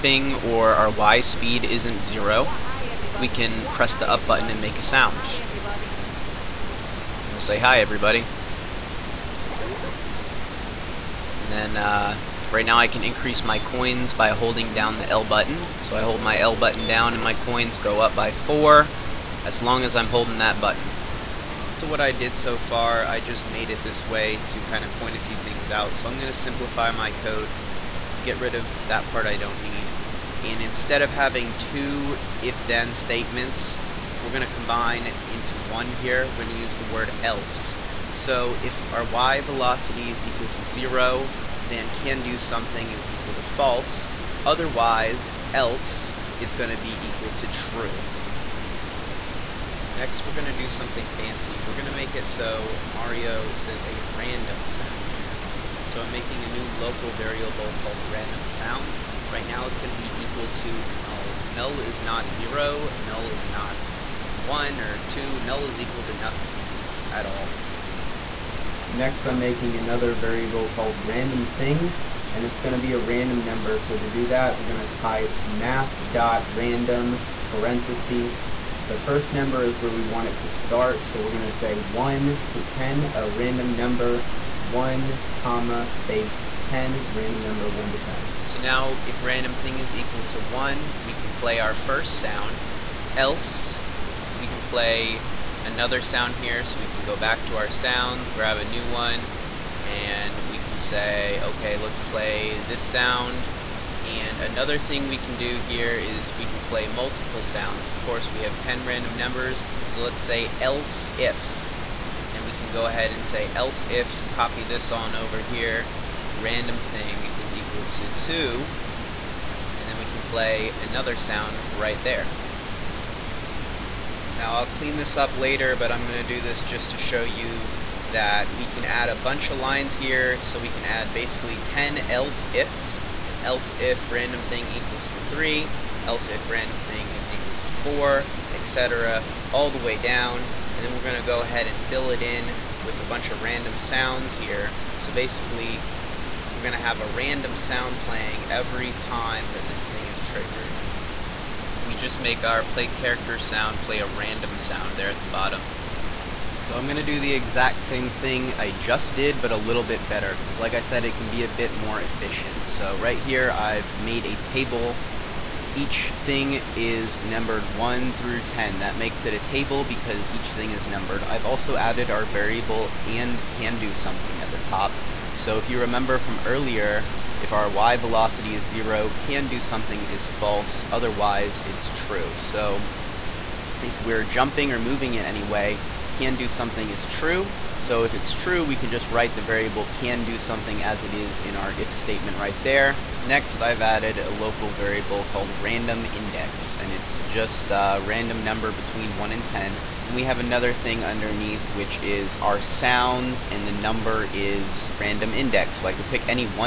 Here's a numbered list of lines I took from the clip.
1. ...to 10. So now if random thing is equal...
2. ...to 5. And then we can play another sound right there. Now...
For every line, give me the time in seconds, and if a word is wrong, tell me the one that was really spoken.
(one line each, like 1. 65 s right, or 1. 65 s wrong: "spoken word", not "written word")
1. 87 s right
2. 117 s wrong: "2", not "5".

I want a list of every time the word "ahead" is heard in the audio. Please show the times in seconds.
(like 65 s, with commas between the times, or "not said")
112 s, 141 s.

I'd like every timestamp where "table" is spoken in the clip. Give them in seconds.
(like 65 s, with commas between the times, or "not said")
164 s, 169 s.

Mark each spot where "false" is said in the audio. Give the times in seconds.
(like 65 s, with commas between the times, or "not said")
43 s, 180 s.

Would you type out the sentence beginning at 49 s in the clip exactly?
Next, we're going to do something fancy.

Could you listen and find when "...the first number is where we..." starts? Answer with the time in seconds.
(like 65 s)
78 s.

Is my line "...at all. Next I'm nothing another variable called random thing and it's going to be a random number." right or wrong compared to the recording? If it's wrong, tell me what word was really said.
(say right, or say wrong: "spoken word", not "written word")
wrong: "making", not "nothing".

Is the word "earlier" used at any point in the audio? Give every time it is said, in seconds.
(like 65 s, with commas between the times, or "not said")
176 s.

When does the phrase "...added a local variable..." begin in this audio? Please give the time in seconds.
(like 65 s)
193 s.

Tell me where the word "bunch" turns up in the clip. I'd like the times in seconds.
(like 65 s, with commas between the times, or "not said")
129 s, 143 s.